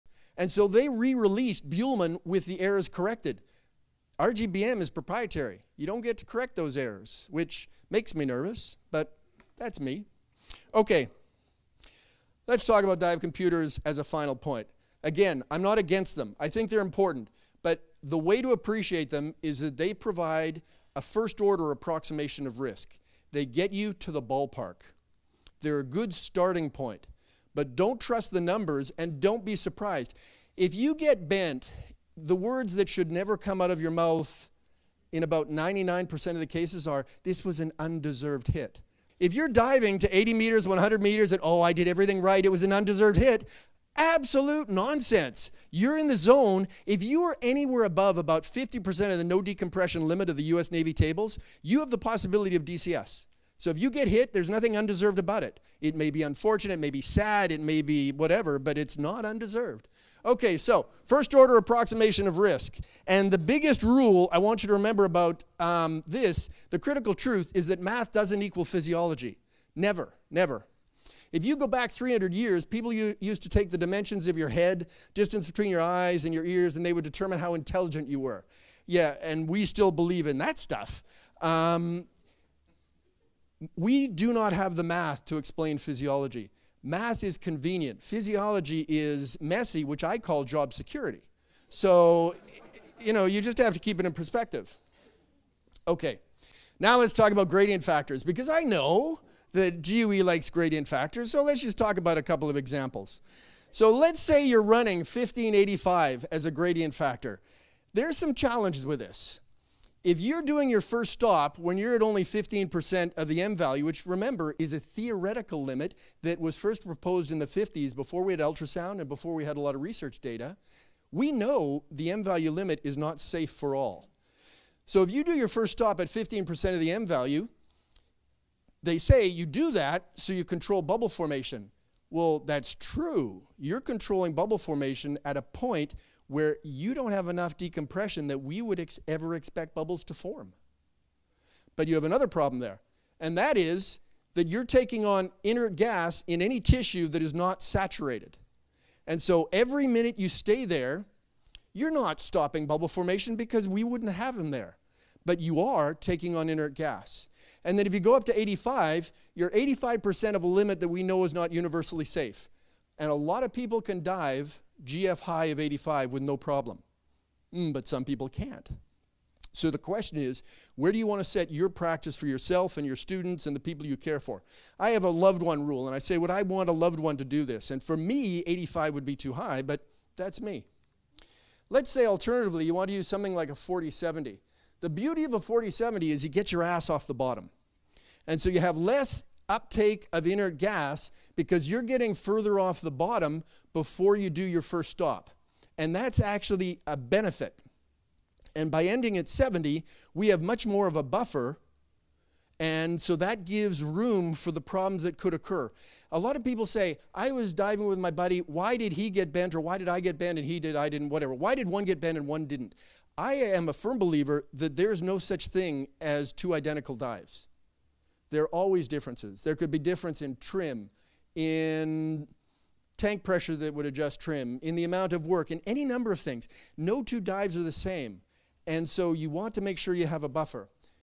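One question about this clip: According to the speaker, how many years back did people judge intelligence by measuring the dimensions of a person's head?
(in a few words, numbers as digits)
300 years.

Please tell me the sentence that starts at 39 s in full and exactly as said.
If you're diving to 80 meters, 100 meters, and oh, I did everything right, it was an undeserved hit, absolute nonsense.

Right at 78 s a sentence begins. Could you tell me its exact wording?
Yeah, and we still believe in that stuff.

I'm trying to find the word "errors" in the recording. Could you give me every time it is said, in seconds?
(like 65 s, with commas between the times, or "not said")
2 s, 6 s.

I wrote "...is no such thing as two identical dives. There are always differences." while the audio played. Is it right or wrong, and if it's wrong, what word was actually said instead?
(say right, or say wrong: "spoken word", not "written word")
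right.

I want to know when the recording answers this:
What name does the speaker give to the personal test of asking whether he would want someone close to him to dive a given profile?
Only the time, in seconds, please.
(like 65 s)
175 s.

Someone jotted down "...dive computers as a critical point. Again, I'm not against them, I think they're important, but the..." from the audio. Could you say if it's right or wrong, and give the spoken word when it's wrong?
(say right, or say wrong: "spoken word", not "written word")
wrong: "final", not "critical".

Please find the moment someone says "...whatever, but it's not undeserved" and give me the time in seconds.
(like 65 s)
58 s.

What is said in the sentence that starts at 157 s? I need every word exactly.
And then if you go up to 85, you're 85% of a limit that we know is not universally safe.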